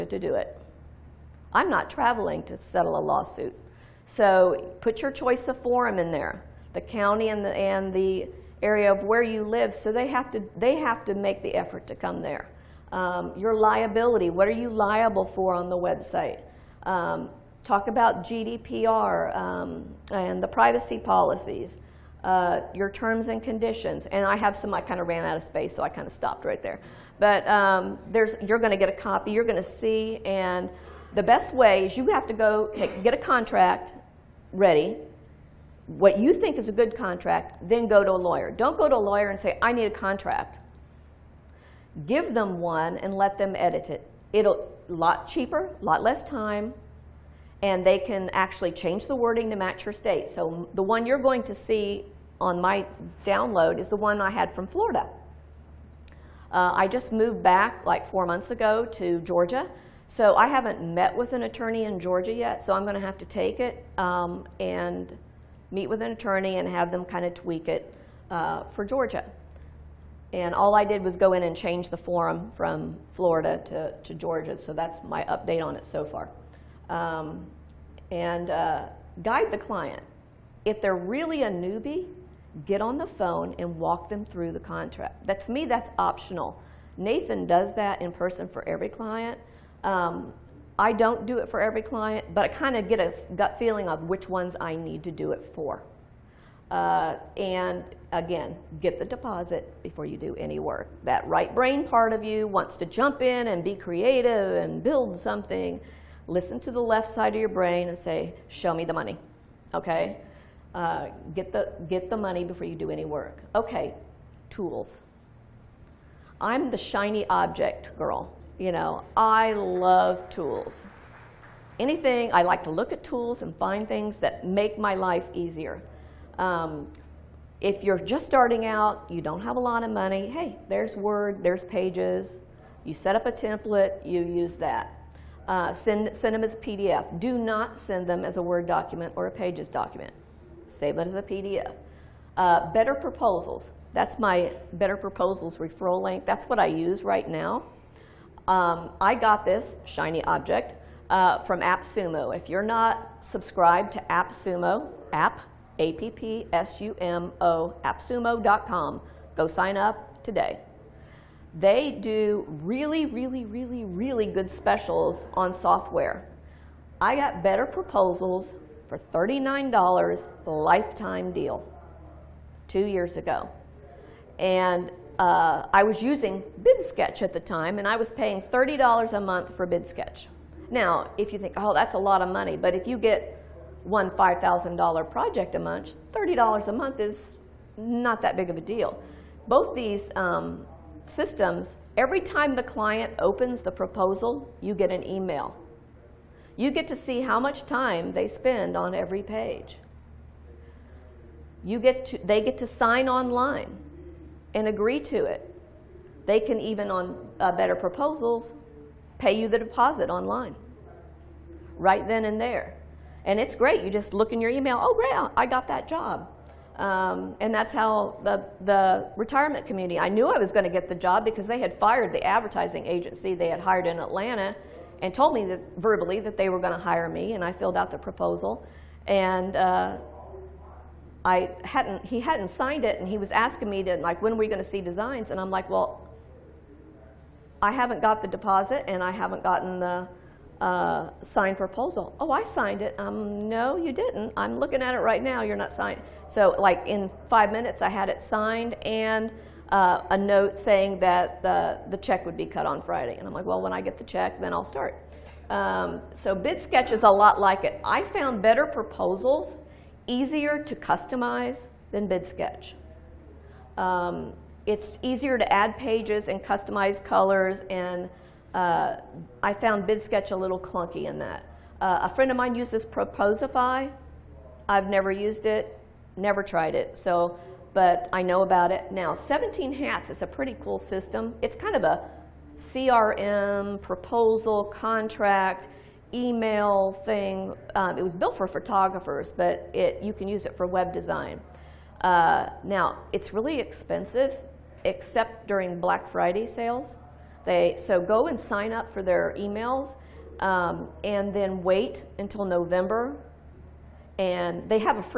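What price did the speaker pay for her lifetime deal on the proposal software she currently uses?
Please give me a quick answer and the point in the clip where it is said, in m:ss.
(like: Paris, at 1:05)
$39, at 2:49.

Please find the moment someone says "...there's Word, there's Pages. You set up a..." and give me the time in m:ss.
2:10.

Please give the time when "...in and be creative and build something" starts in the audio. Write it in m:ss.
1:43.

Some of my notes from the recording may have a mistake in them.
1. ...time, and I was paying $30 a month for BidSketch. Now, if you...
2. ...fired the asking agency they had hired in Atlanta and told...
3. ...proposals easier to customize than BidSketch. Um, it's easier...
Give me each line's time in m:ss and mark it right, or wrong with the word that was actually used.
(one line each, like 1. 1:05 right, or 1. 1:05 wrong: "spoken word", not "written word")
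1. 2:57 right
2. 3:41 wrong: "advertising", not "asking"
3. 4:18 right.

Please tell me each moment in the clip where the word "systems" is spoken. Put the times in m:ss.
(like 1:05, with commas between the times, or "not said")
3:11, 4:40.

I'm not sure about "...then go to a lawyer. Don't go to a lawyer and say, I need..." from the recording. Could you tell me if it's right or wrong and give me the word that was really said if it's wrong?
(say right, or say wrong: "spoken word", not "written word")
right.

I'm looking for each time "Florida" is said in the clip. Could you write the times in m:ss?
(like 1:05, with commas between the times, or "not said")
0:54, 1:13.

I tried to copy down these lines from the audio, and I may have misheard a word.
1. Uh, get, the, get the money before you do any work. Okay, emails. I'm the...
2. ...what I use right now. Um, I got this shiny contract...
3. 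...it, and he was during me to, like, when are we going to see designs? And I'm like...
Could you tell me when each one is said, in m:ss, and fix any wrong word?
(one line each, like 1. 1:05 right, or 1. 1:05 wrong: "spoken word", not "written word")
1. 1:50 wrong: "tools", not "emails"
2. 2:26 wrong: "object", not "contract"
3. 3:52 wrong: "asking", not "during".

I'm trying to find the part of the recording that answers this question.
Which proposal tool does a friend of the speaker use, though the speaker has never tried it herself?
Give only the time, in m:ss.
4:32.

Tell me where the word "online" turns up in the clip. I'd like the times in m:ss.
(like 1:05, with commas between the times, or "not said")
3:23, 3:30.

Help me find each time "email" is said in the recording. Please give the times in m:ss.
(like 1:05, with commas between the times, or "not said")
3:15, 3:34, 4:46, 4:59.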